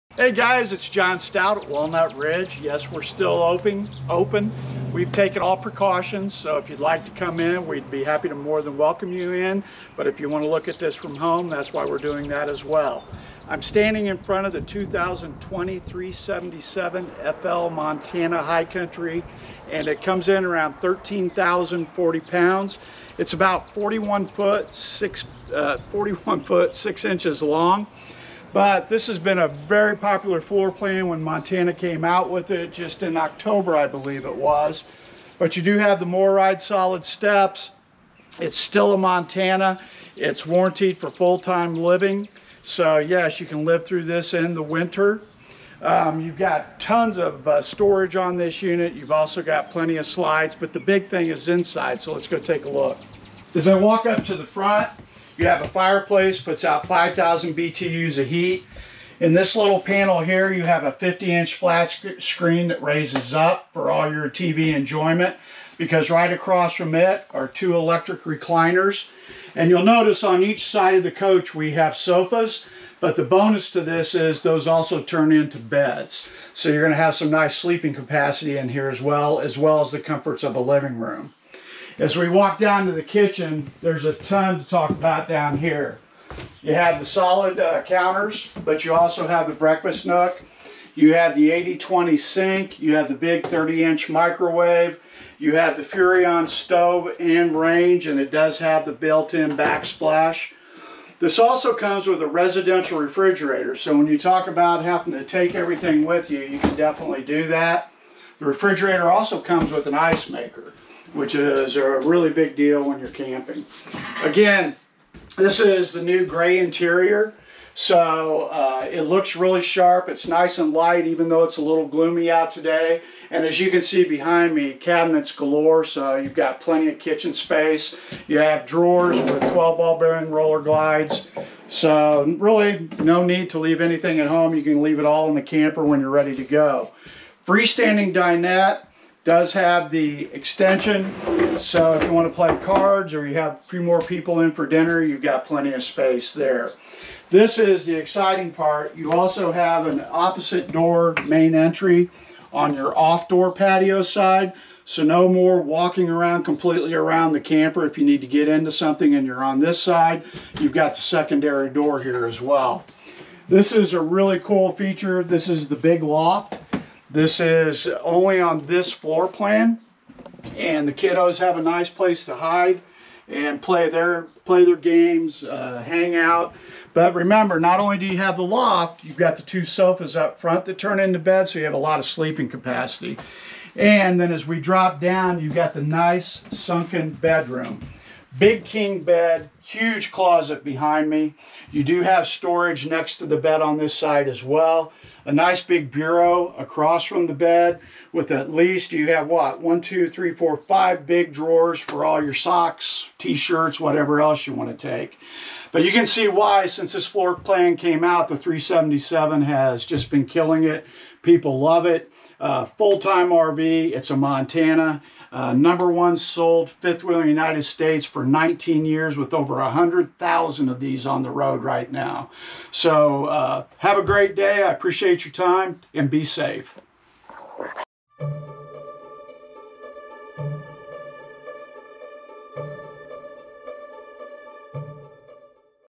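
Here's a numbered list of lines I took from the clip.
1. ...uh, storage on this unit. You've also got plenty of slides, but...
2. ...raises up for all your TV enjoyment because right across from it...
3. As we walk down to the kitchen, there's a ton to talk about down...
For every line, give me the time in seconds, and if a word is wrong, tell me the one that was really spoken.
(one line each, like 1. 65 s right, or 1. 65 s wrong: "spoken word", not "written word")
1. 47 s right
2. 62 s right
3. 82 s right.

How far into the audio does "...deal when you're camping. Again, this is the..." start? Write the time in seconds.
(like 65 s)
112 s.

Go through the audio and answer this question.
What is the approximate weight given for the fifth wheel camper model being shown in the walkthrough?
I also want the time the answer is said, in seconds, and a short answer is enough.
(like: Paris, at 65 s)
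13,040 pounds, at 20 s.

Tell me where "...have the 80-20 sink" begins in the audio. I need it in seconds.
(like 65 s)
91 s.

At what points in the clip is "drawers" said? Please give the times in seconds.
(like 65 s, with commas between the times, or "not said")
128 s, 201 s.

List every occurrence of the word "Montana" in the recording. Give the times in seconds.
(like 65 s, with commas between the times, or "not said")
17 s, 31 s, 38 s, 214 s.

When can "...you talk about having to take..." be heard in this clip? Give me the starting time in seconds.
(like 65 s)
104 s.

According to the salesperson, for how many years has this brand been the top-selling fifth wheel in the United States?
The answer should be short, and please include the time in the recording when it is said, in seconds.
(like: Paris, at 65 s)
19 years, at 218 s.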